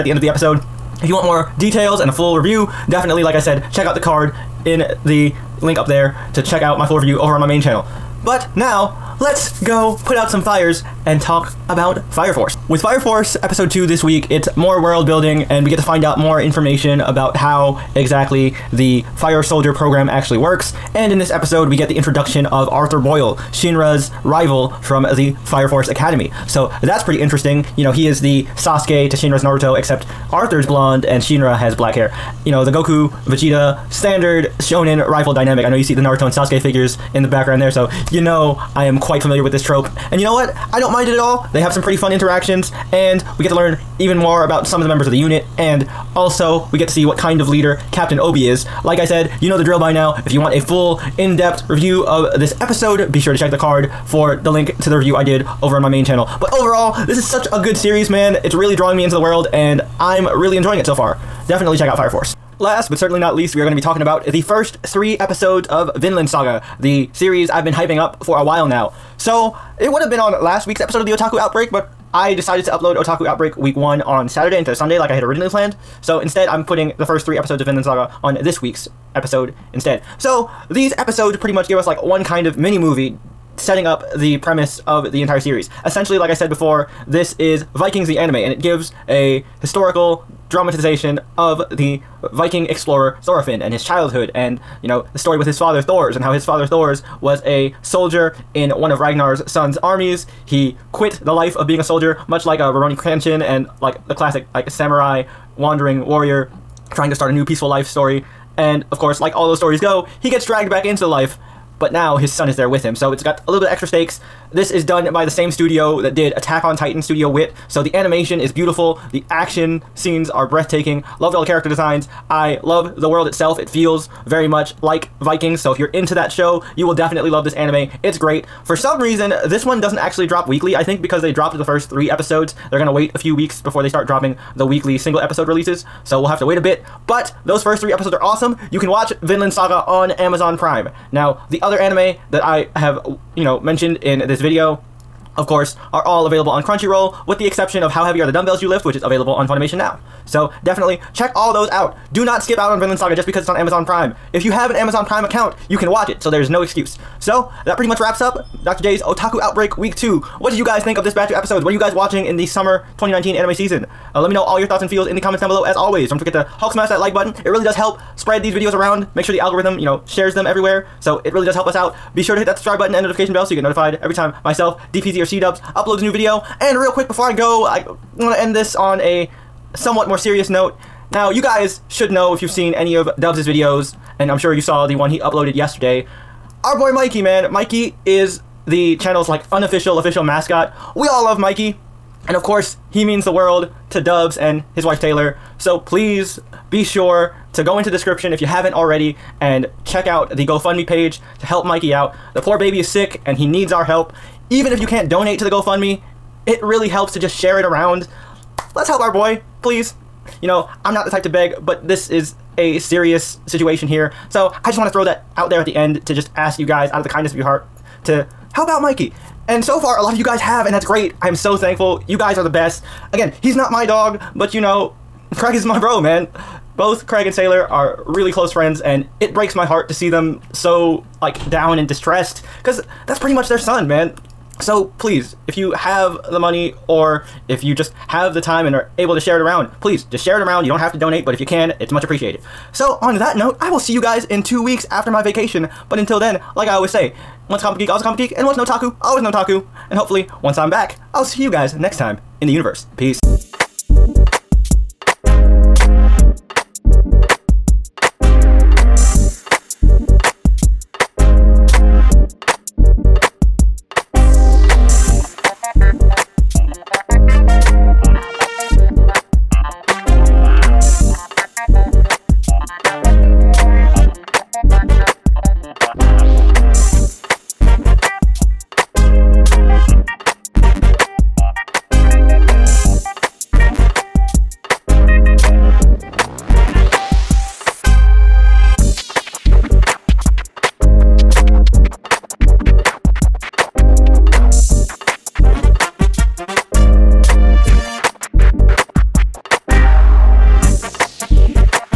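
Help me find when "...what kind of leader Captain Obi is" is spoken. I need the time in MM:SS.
00:47.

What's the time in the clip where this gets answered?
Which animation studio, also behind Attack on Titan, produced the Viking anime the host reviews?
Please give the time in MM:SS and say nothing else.
01:57.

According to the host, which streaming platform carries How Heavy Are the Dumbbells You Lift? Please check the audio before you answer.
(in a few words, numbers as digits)
Funimation.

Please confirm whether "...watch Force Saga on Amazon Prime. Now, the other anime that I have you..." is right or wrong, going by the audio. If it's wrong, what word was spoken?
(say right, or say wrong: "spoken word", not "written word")
wrong: "Vinland", not "Force".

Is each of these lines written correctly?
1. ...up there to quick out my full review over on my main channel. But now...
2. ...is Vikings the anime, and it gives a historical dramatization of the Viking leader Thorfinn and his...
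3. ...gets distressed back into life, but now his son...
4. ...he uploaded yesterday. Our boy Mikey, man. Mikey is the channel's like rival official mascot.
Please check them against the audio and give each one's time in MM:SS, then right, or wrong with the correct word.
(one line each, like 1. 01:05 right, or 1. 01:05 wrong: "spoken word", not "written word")
1. 00:05 wrong: "check", not "quick"
2. 01:27 wrong: "explorer", not "leader"
3. 01:50 wrong: "dragged", not "distressed"
4. 03:05 wrong: "unofficial", not "rival".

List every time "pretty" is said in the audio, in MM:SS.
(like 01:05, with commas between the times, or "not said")
00:27, 00:41, 01:21, 02:37, 03:53.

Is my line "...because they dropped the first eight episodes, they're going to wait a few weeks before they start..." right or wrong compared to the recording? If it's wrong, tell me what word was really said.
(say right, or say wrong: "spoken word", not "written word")
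wrong: "three", not "eight".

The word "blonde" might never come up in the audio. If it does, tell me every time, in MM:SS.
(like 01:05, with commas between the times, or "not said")
00:30.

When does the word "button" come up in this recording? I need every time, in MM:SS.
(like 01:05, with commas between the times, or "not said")
02:47, 02:52.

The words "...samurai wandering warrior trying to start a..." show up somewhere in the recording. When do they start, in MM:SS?
01:44.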